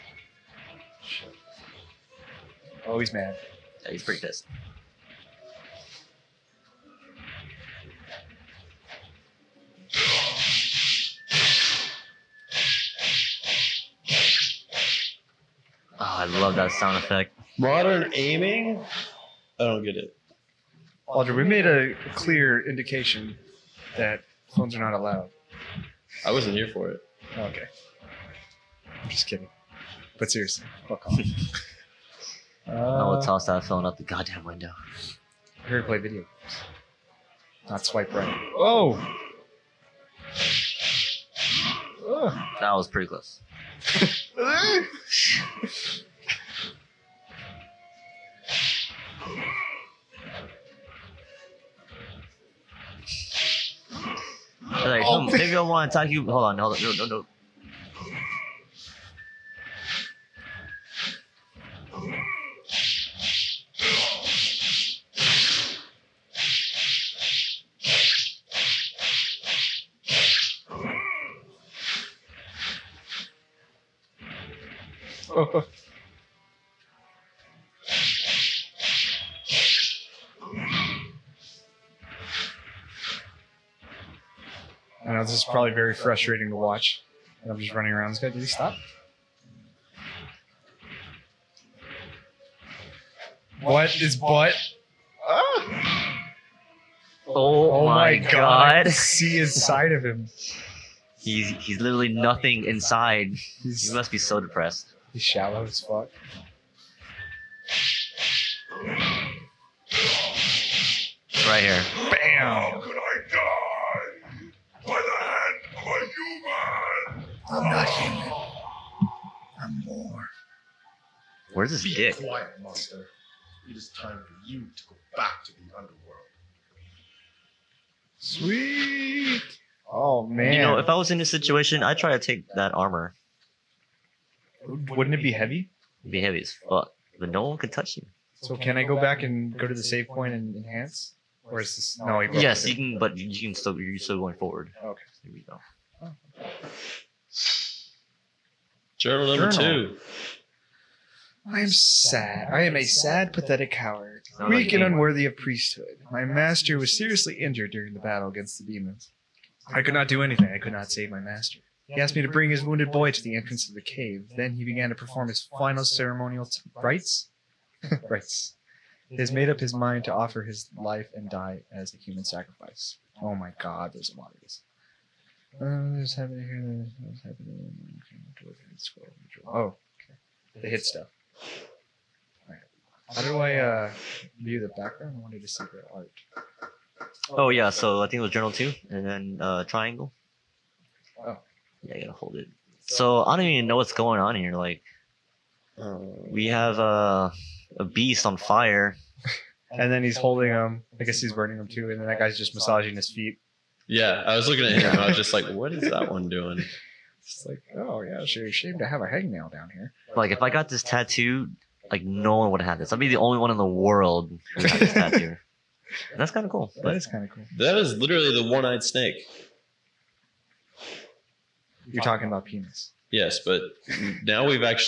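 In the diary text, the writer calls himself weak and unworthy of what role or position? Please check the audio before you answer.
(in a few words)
priesthood.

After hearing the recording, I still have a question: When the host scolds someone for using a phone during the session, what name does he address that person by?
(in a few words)
Audrey.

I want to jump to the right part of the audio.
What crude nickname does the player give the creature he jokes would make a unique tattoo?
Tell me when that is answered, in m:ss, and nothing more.
3:38.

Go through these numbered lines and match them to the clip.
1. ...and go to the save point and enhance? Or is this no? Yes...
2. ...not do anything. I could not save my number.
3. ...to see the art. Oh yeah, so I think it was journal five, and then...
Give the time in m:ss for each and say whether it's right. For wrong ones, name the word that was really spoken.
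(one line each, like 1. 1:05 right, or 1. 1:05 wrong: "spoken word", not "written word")
1. 2:19 right
2. 2:39 wrong: "master", not "number"
3. 3:05 wrong: "two", not "five".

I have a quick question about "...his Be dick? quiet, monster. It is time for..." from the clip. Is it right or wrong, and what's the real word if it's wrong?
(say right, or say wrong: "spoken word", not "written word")
right.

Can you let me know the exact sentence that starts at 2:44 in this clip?
Then he began to perform his final ceremonial t- rites.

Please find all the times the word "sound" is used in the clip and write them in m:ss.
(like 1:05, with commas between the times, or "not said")
0:16.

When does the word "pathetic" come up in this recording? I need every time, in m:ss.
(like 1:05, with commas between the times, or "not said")
2:33.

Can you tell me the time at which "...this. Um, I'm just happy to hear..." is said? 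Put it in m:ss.
2:54.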